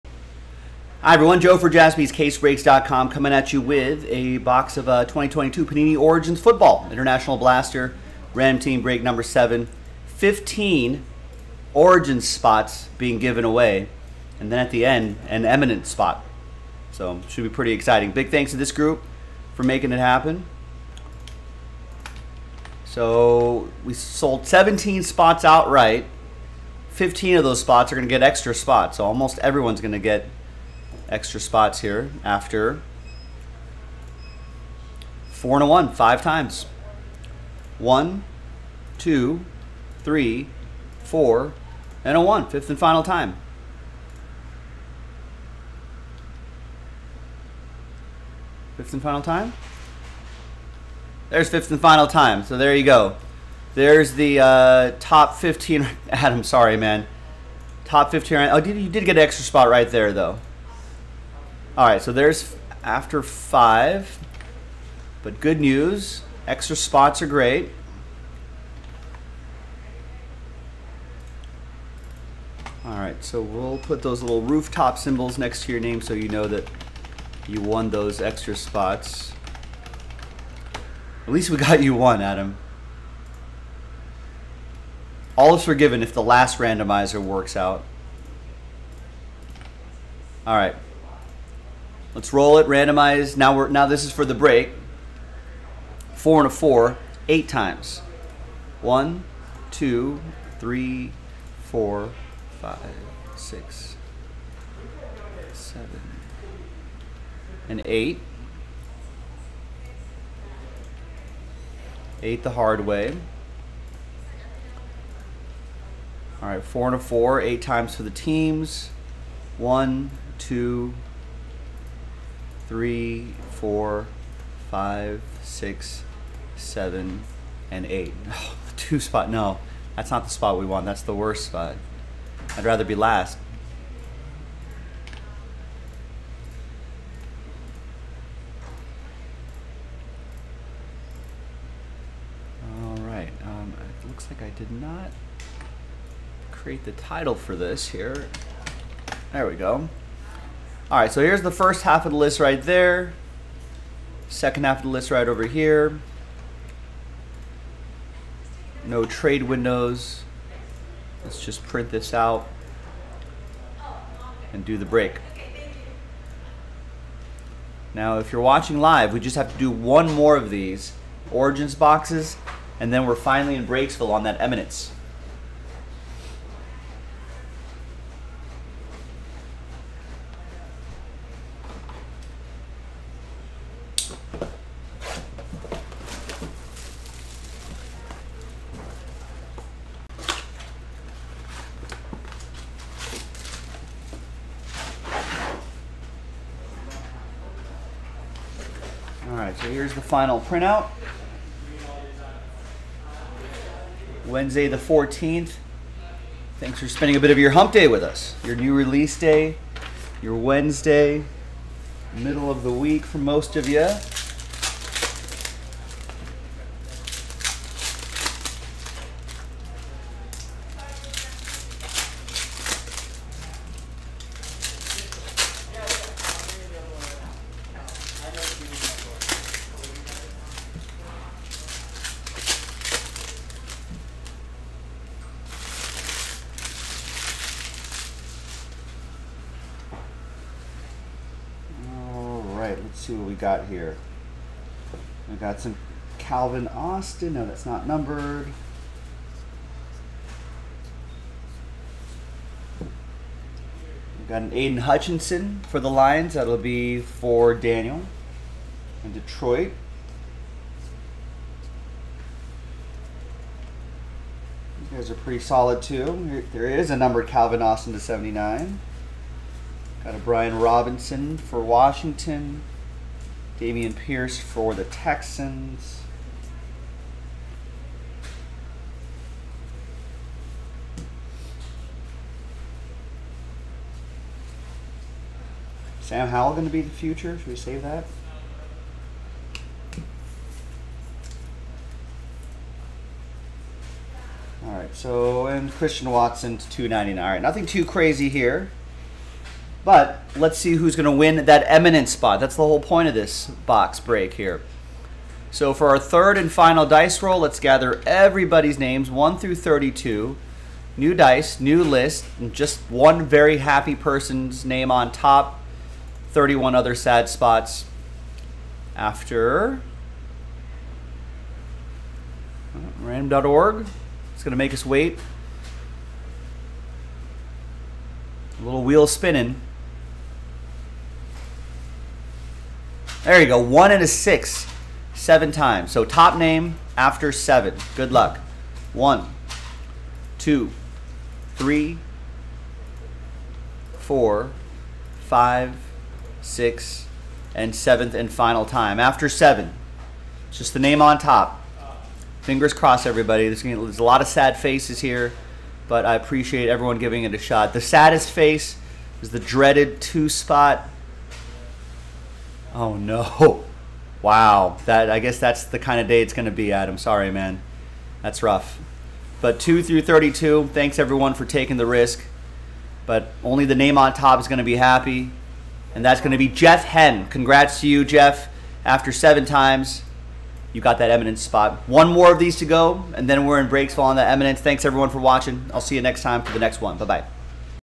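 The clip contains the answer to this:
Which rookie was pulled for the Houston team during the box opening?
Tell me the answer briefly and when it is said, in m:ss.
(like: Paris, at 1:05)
Dameon Pierce, at 4:33.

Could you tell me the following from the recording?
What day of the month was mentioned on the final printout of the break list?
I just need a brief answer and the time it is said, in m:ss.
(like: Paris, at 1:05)
14th, at 3:24.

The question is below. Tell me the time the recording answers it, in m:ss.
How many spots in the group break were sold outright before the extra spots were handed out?
0:24.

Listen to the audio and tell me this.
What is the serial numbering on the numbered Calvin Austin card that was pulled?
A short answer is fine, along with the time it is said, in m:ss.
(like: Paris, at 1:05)
79, at 4:27.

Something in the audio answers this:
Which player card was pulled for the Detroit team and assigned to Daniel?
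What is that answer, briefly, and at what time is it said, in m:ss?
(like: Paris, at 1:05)
Aidan Hutchinson, at 4:14.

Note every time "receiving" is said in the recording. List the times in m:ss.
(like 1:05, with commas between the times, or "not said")
not said.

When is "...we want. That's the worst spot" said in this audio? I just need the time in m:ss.
2:10.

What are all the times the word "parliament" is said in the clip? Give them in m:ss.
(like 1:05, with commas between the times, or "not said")
not said.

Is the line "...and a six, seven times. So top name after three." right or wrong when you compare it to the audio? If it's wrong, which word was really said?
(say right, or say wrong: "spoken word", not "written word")
wrong: "seven", not "three".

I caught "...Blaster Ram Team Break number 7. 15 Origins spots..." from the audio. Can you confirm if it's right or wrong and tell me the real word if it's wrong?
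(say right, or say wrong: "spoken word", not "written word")
right.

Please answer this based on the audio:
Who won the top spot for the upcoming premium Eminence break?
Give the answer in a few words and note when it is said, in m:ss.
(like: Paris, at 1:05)
Jeff Hen, at 6:16.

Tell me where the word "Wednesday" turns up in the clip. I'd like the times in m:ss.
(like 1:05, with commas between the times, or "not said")
3:24, 3:30.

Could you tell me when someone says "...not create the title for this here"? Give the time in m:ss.
2:24.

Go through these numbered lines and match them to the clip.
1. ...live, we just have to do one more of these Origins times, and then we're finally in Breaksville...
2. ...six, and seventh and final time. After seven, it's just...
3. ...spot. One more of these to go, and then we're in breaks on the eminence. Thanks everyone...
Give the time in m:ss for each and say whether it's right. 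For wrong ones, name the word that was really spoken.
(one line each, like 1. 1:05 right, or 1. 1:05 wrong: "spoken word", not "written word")
1. 2:48 wrong: "boxes", not "times"
2. 5:46 right
3. 6:21 right.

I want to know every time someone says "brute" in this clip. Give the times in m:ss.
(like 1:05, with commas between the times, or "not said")
not said.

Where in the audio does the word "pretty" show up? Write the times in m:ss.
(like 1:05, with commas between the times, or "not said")
0:17, 4:25.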